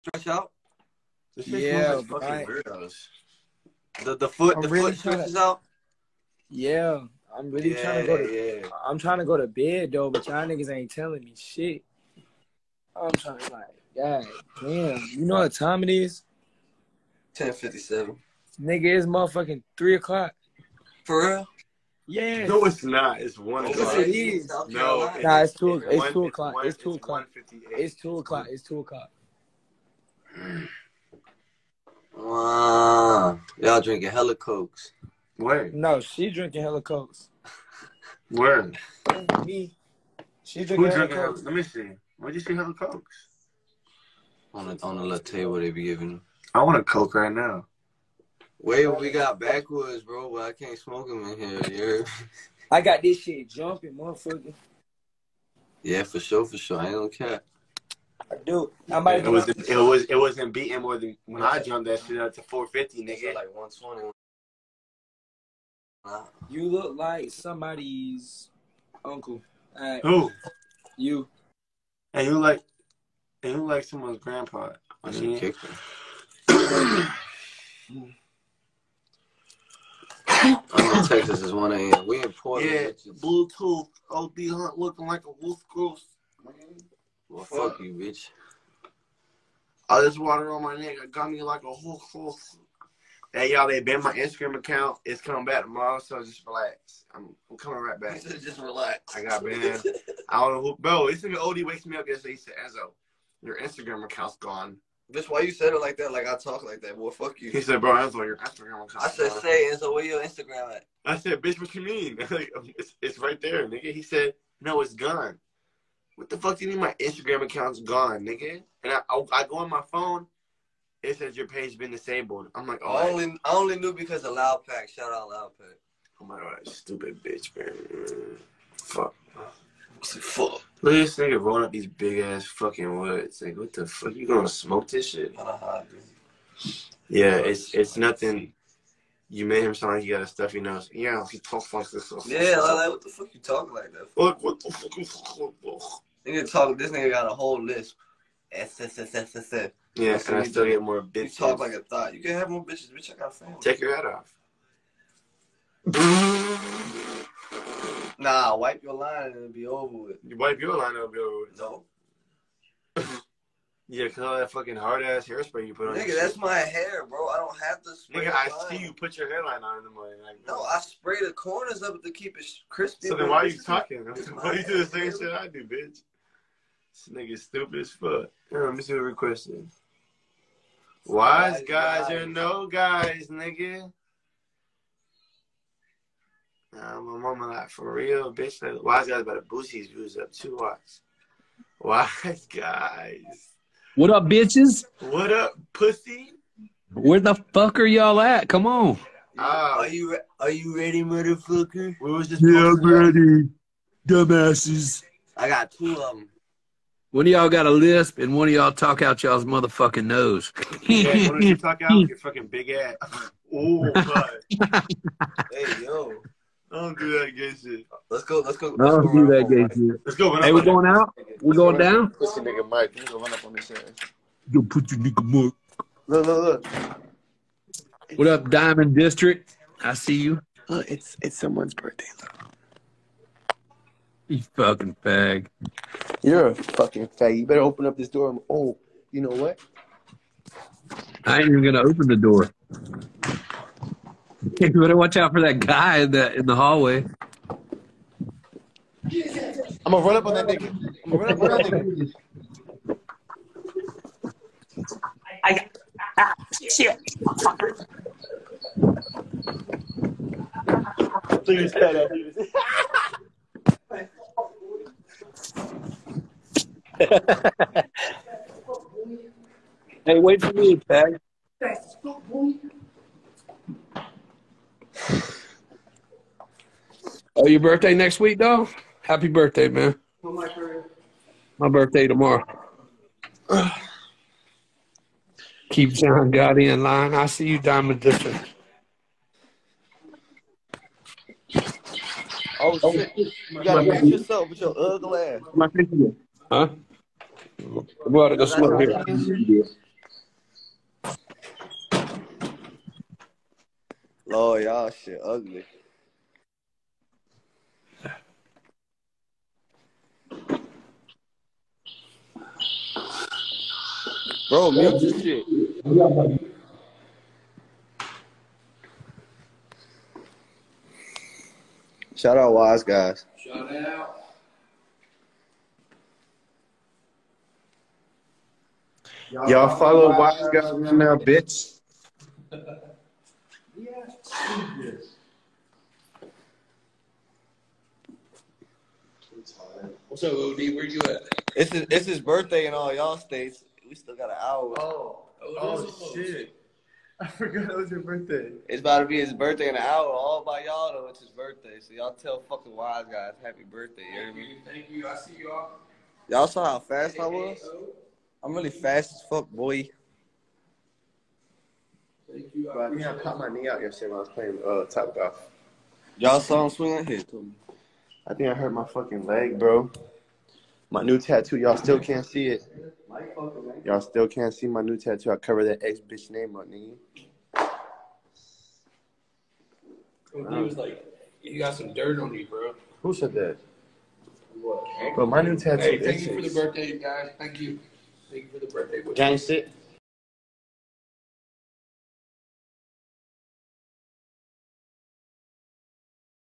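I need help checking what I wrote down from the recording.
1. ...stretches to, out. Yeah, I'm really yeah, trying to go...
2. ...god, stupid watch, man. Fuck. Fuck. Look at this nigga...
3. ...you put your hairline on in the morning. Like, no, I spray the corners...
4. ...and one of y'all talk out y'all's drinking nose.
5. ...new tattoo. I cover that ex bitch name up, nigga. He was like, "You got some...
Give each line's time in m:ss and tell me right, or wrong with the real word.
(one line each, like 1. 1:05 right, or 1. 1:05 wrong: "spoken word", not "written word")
1. 0:05 right
2. 2:06 wrong: "bitch", not "watch"
3. 2:48 right
4. 3:28 wrong: "motherfucking", not "drinking"
5. 6:14 right.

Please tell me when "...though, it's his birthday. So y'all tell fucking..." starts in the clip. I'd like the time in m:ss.
5:50.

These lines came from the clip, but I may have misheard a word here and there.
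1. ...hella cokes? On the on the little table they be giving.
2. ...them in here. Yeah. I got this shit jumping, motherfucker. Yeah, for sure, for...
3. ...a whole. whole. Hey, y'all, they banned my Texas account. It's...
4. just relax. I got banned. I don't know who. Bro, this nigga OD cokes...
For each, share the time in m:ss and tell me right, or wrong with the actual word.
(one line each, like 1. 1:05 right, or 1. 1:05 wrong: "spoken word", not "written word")
1. 0:42 right
2. 0:51 right
3. 1:31 wrong: "Instagram", not "Texas"
4. 1:38 wrong: "wakes", not "cokes".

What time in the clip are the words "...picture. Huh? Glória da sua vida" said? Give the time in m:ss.
4:55.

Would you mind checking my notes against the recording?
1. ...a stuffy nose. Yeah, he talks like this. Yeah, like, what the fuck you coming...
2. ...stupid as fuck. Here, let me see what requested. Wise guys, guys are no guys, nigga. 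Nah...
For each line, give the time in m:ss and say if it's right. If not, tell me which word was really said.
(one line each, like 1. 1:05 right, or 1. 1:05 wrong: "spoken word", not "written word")
1. 2:20 wrong: "talking", not "coming"
2. 2:57 right.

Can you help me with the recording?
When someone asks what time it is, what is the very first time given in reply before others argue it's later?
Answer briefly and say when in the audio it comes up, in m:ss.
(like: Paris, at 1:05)
10:57, at 0:17.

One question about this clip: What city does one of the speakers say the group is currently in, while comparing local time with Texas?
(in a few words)
Portland.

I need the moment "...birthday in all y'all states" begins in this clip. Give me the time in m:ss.
5:42.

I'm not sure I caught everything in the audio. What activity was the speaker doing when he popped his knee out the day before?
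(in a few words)
Topgolf.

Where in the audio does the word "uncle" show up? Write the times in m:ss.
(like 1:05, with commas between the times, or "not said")
1:09.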